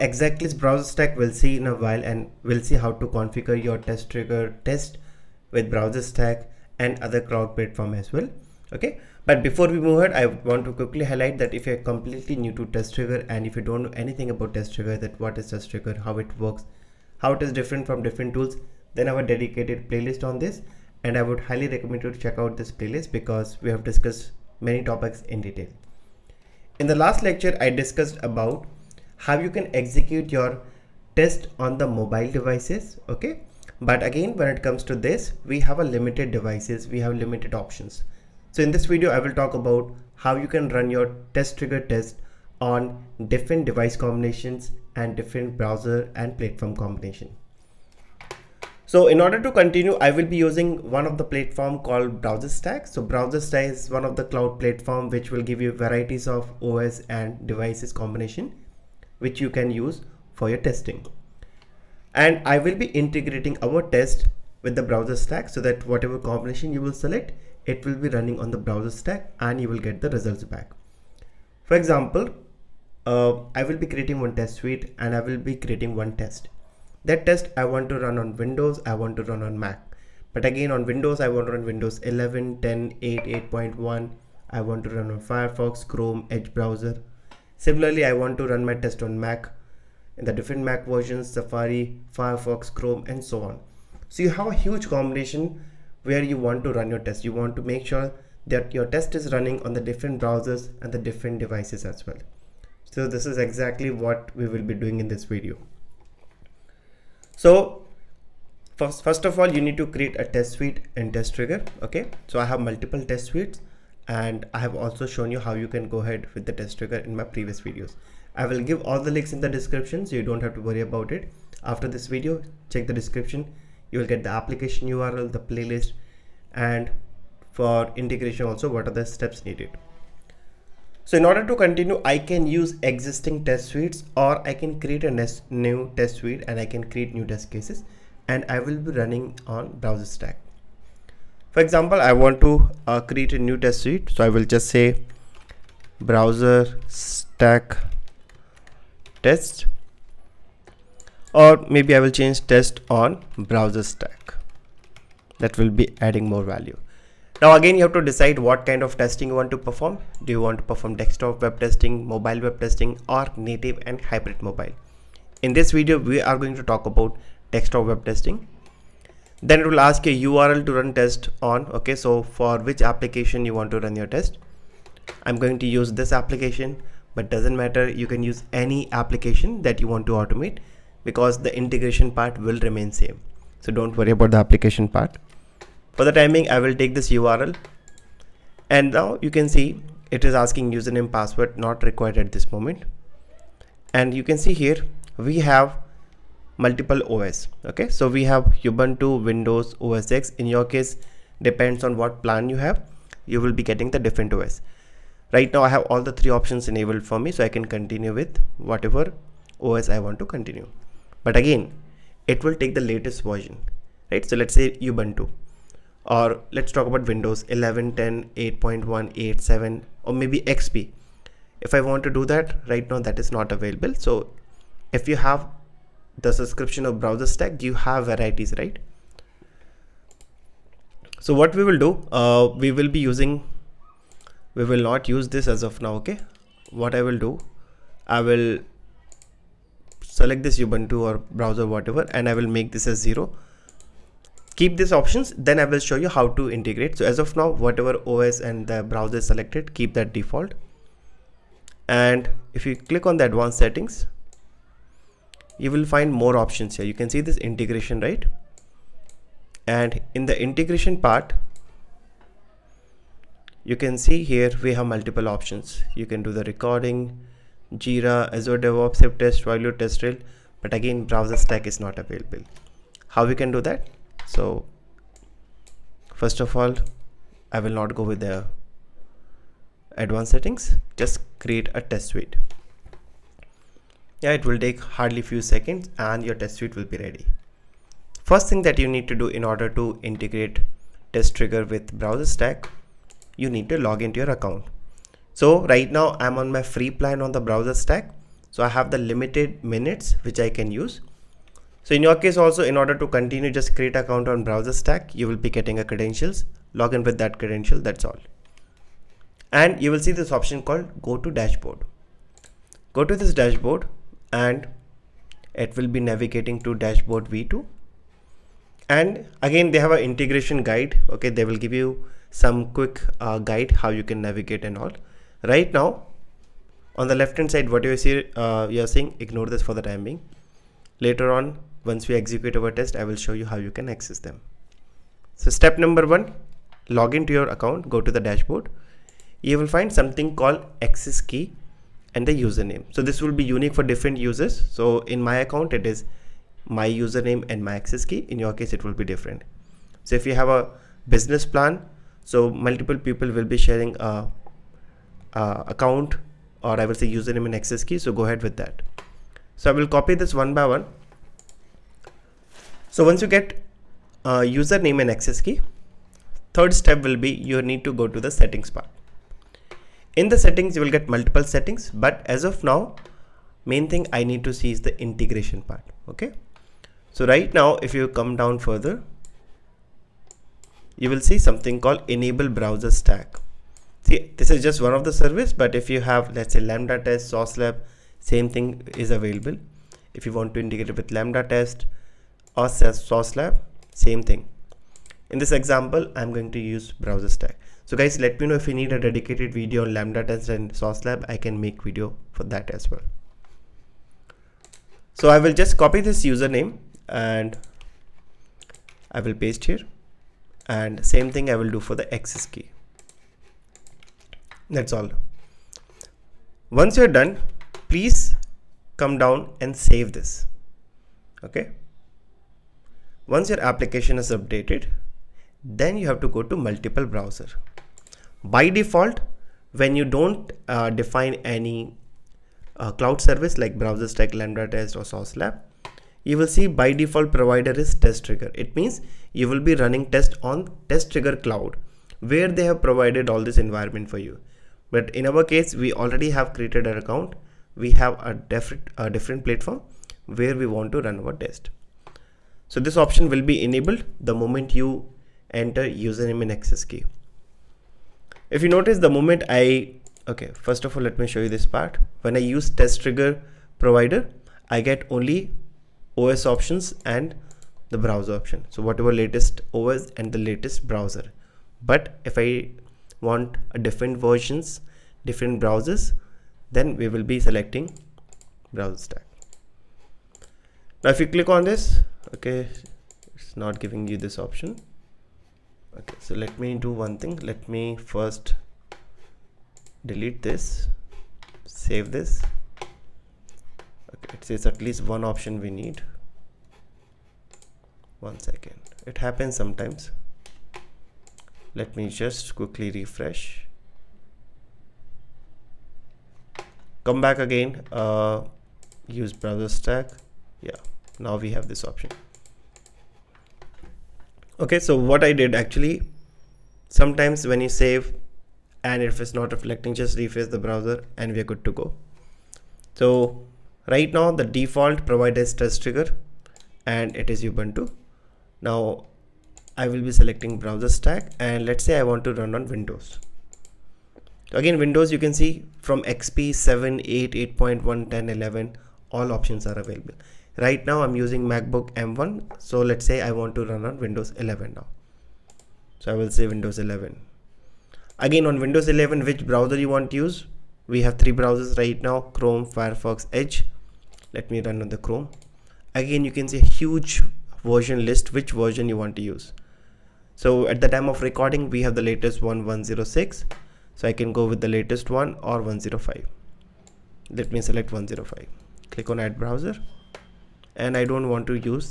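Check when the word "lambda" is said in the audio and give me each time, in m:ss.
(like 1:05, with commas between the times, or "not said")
6:26, 6:31, 6:39, 7:14.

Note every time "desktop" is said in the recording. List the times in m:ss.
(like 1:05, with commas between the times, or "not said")
2:40, 2:47.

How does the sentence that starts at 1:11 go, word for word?
For example, uh, I will be creating one test suite and I will be creating one test.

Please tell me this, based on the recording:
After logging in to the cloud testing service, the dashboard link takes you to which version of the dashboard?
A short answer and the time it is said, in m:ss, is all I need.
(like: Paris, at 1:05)
Dashboard v2, at 5:16.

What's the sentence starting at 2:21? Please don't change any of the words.
For example, I want to uh, create a new test suite.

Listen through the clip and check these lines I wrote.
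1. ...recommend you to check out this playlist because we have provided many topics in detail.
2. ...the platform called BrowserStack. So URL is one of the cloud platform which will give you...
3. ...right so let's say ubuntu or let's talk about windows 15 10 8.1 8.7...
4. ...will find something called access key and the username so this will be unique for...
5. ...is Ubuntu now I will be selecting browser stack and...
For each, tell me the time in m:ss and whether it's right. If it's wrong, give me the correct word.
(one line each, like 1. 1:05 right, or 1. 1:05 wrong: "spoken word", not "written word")
1. 0:21 wrong: "discussed", not "provided"
2. 0:51 wrong: "BrowserStack", not "URL"
3. 3:34 wrong: "11", not "15"
4. 5:39 right
5. 8:47 right.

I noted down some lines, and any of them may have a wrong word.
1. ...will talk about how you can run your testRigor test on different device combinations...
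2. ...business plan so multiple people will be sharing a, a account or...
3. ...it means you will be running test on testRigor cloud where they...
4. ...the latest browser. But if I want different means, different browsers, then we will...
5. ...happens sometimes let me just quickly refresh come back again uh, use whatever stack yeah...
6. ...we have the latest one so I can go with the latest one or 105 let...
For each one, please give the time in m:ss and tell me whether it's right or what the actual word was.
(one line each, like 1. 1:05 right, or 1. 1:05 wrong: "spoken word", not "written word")
1. 0:39 right
2. 5:51 right
3. 7:18 right
4. 7:50 wrong: "versions", not "means"
5. 8:19 wrong: "browser", not "whatever"
6. 9:21 right.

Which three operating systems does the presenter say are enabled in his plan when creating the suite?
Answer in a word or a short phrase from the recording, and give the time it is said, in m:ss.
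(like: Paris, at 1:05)
Ubuntu, Windows, OS X, at 3:18.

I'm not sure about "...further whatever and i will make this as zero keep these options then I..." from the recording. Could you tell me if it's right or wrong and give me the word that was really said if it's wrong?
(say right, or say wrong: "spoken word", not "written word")
wrong: "browser", not "further".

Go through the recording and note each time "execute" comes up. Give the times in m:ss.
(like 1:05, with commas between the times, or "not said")
0:29, 5:32.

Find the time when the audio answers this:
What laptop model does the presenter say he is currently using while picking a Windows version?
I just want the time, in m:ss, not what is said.
9:01.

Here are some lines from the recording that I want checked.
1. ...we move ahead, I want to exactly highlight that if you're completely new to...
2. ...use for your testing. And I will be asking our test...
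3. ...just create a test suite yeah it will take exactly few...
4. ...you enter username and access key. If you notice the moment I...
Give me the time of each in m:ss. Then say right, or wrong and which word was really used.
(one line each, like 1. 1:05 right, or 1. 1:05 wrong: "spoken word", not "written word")
1. 0:09 wrong: "quickly", not "exactly"
2. 0:59 wrong: "integrating", not "asking"
3. 4:40 wrong: "hardly", not "exactly"
4. 7:34 right.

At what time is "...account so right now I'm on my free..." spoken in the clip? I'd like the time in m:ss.
4:54.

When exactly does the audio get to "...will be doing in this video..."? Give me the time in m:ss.
1:44.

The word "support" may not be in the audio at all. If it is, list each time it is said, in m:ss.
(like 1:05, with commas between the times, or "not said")
not said.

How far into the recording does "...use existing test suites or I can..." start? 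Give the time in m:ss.
2:12.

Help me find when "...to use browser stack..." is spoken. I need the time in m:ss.
6:36.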